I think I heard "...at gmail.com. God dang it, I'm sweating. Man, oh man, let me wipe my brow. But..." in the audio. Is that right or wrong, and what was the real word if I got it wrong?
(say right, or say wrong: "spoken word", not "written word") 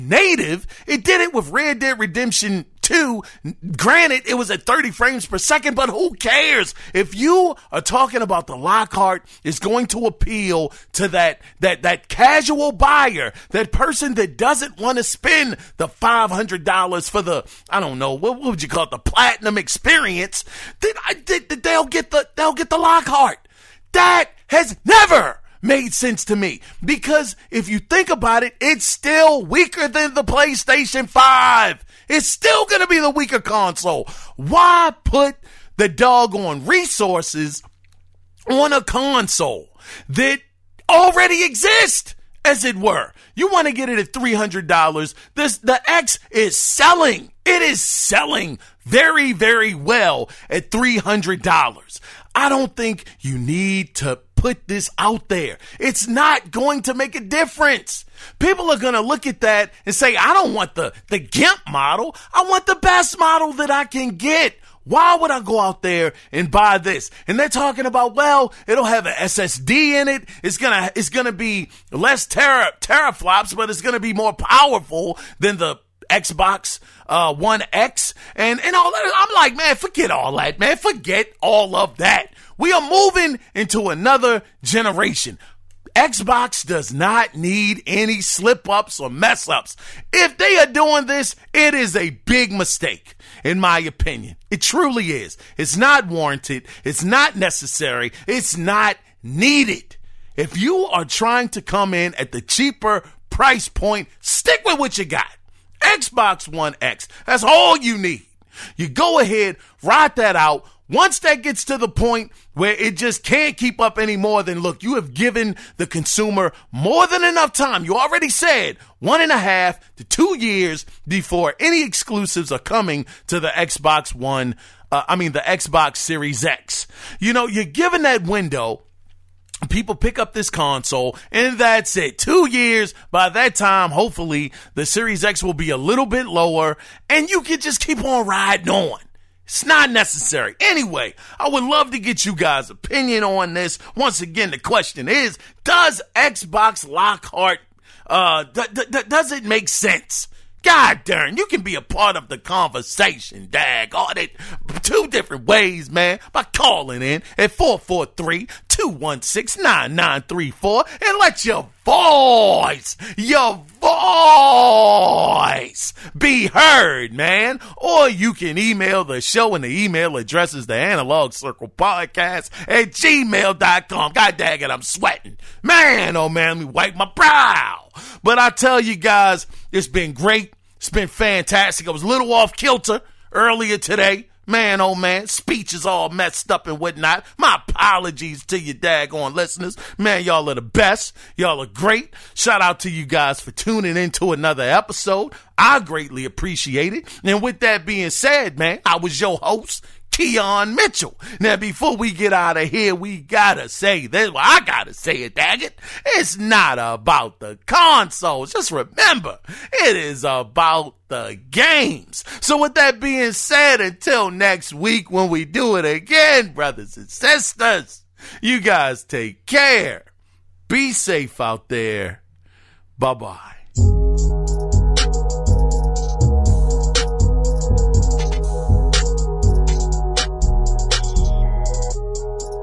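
right.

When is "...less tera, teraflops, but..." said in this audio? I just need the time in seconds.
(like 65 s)
71 s.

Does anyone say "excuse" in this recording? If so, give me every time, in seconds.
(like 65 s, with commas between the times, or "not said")
not said.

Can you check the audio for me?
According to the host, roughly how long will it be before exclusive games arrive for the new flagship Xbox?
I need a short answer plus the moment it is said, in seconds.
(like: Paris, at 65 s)
1.5 to 2 years, at 118 s.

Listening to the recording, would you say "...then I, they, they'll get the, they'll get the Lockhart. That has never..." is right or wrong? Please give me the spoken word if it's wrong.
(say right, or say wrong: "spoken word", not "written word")
right.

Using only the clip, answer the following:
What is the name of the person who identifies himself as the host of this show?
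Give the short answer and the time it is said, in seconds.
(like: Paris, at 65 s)
Kiaun Mitchell, at 200 s.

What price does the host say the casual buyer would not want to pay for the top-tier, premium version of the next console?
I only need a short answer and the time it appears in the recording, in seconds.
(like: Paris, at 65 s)
$500, at 15 s.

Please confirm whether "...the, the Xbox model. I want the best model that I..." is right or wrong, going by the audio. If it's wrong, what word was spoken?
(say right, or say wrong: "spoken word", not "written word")
wrong: "GIMP", not "Xbox".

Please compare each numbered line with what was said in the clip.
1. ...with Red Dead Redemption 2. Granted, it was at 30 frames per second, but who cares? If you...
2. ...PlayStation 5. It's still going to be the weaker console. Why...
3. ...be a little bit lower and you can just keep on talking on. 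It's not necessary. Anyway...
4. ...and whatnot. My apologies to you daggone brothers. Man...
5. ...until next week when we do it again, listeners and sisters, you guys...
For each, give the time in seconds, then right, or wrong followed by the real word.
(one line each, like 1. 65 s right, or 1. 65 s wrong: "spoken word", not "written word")
1. 1 s right
2. 30 s right
3. 135 s wrong: "riding", not "talking"
4. 186 s wrong: "listeners", not "brothers"
5. 213 s wrong: "brothers", not "listeners".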